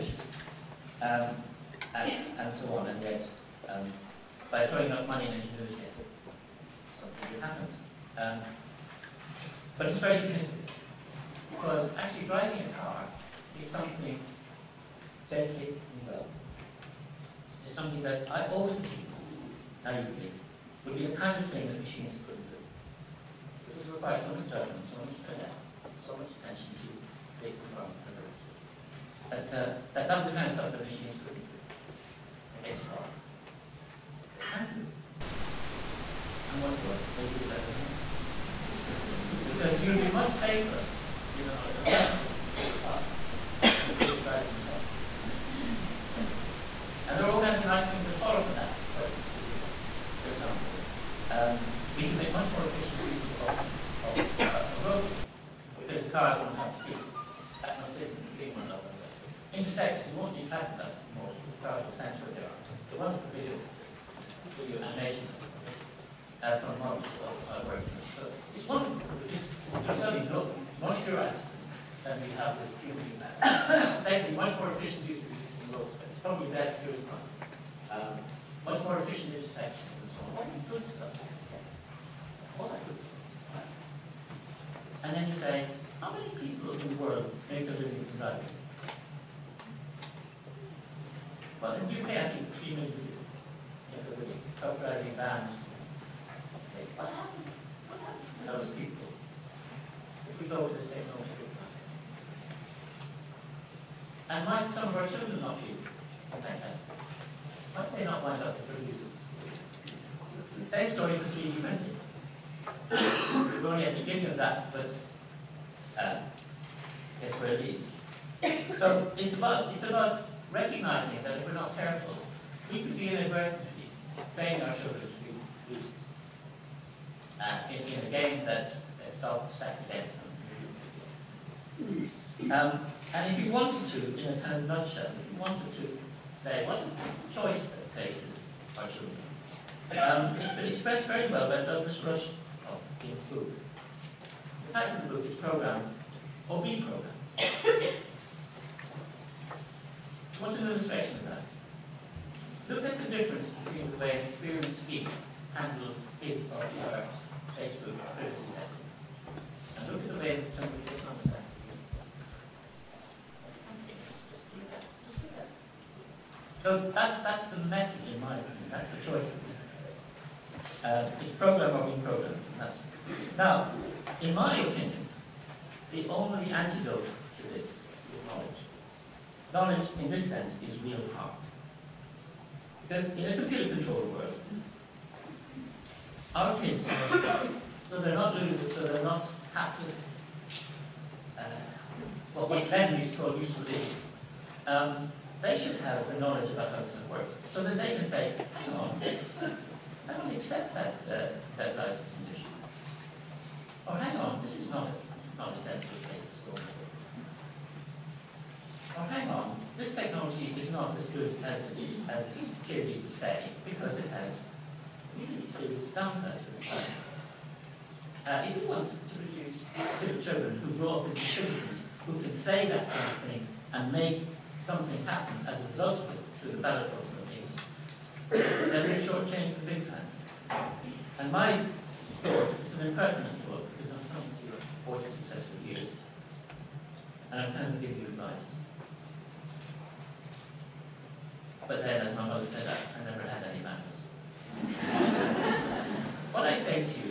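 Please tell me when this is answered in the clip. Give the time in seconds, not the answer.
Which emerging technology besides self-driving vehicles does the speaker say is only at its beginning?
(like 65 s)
111 s.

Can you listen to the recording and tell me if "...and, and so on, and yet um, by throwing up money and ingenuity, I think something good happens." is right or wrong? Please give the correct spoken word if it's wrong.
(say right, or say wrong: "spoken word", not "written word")
right.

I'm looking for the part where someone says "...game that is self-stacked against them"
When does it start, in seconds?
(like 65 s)
128 s.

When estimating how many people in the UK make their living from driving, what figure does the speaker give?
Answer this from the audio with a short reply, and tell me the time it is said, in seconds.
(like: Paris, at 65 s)
3 million, at 92 s.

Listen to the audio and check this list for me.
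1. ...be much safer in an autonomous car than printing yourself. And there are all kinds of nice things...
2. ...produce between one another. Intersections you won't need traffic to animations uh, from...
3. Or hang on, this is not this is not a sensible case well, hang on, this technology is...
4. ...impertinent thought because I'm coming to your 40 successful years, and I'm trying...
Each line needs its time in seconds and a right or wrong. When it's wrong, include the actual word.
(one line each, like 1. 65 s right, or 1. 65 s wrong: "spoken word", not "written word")
1. 39 s wrong: "driving", not "printing"
2. 57 s wrong: "distance", not "produce"
3. 203 s right
4. 232 s right.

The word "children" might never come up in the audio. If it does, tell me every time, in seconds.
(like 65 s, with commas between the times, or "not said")
105 s, 138 s, 220 s.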